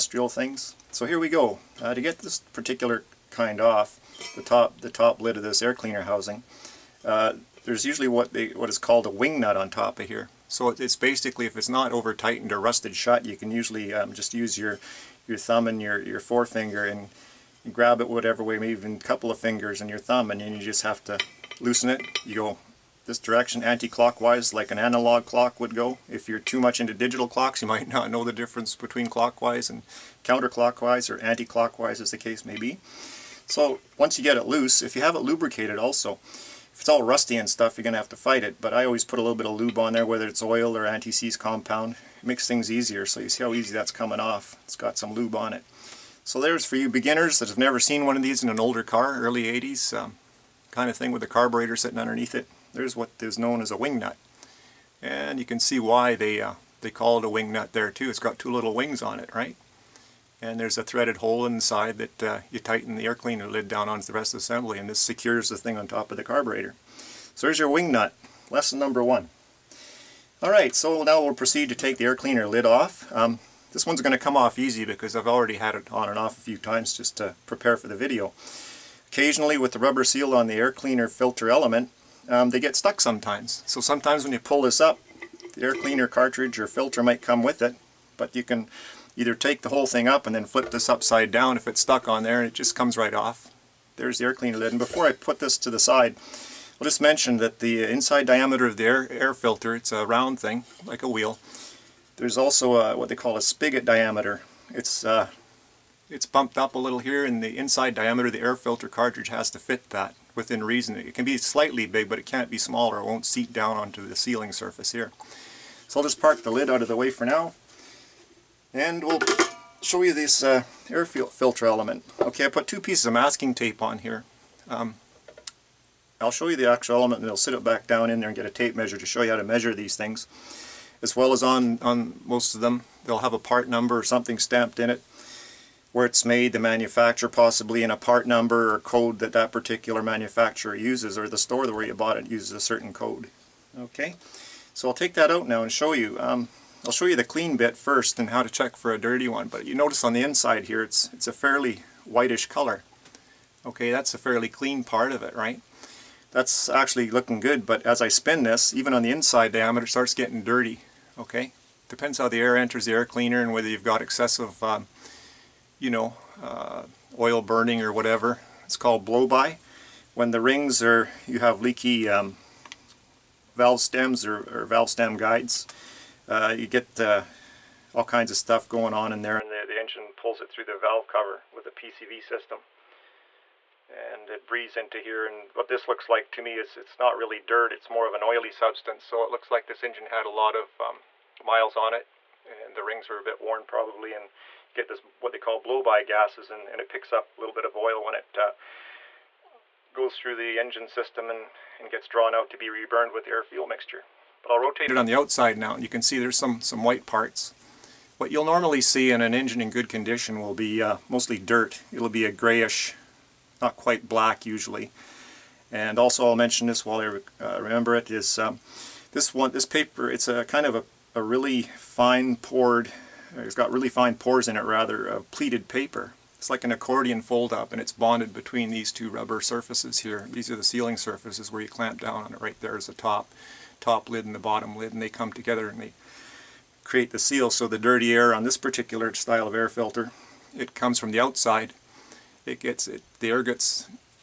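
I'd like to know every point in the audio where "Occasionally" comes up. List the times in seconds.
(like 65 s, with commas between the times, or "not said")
79 s.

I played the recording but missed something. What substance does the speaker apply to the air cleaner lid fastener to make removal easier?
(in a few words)
anti-seize compound.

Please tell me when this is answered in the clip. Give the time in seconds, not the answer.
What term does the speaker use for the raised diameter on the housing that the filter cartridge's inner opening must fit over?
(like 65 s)
103 s.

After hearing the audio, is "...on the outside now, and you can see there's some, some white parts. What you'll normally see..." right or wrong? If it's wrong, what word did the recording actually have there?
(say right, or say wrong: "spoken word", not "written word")
right.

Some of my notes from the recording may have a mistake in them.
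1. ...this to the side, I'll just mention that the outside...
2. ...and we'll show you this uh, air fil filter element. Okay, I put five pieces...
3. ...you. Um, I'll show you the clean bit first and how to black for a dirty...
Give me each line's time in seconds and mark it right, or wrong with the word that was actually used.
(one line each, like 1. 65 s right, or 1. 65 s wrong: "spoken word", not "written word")
1. 95 s wrong: "inside", not "outside"
2. 118 s wrong: "two", not "five"
3. 145 s wrong: "check", not "black".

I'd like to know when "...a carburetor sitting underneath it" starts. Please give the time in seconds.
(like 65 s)
51 s.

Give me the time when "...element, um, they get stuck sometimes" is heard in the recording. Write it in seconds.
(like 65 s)
81 s.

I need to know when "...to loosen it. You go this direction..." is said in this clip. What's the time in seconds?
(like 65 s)
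21 s.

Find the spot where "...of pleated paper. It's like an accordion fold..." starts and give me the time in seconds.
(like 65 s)
225 s.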